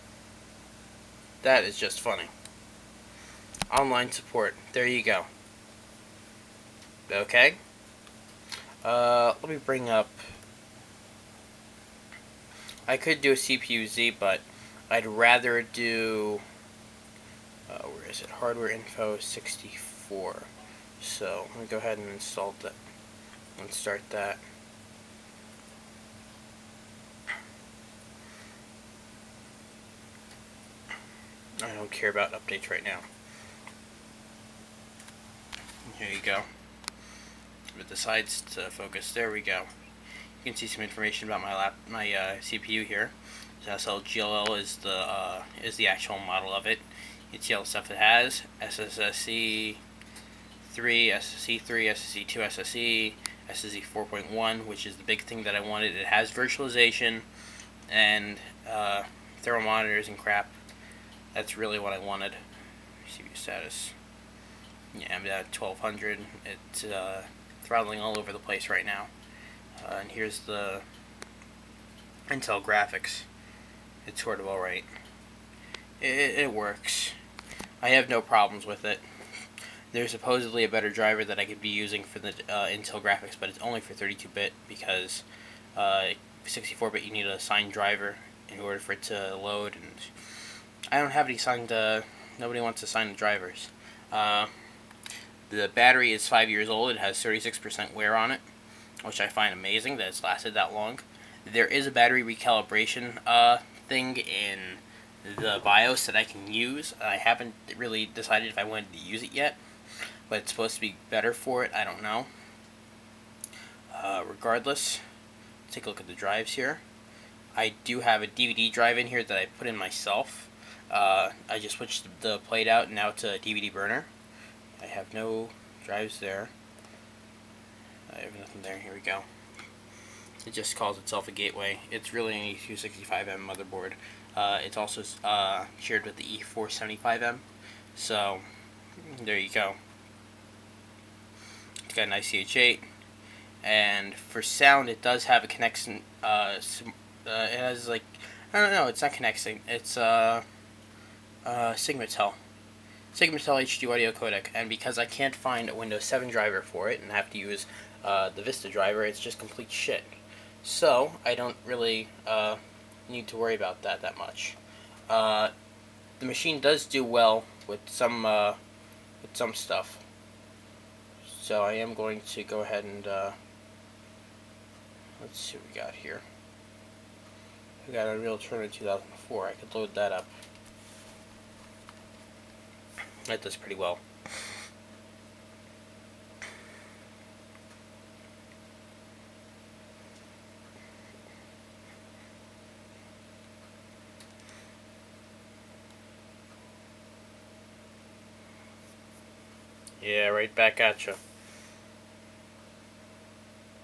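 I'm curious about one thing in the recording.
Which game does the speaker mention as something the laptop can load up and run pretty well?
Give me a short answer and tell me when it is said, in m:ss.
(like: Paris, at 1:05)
Unreal Tournament 2004, at 2:58.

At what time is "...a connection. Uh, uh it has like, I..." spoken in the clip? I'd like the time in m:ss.
2:25.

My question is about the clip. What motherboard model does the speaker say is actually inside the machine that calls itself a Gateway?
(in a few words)
E265M.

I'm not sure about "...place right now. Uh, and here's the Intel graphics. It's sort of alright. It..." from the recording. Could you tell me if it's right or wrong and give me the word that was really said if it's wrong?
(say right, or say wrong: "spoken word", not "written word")
right.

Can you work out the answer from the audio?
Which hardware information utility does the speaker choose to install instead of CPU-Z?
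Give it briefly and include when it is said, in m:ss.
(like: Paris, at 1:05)
Hardware Info 64, at 0:18.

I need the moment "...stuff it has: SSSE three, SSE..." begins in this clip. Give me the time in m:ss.
0:47.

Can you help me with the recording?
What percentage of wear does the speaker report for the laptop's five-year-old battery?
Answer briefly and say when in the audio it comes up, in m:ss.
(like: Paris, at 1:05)
36%, at 1:37.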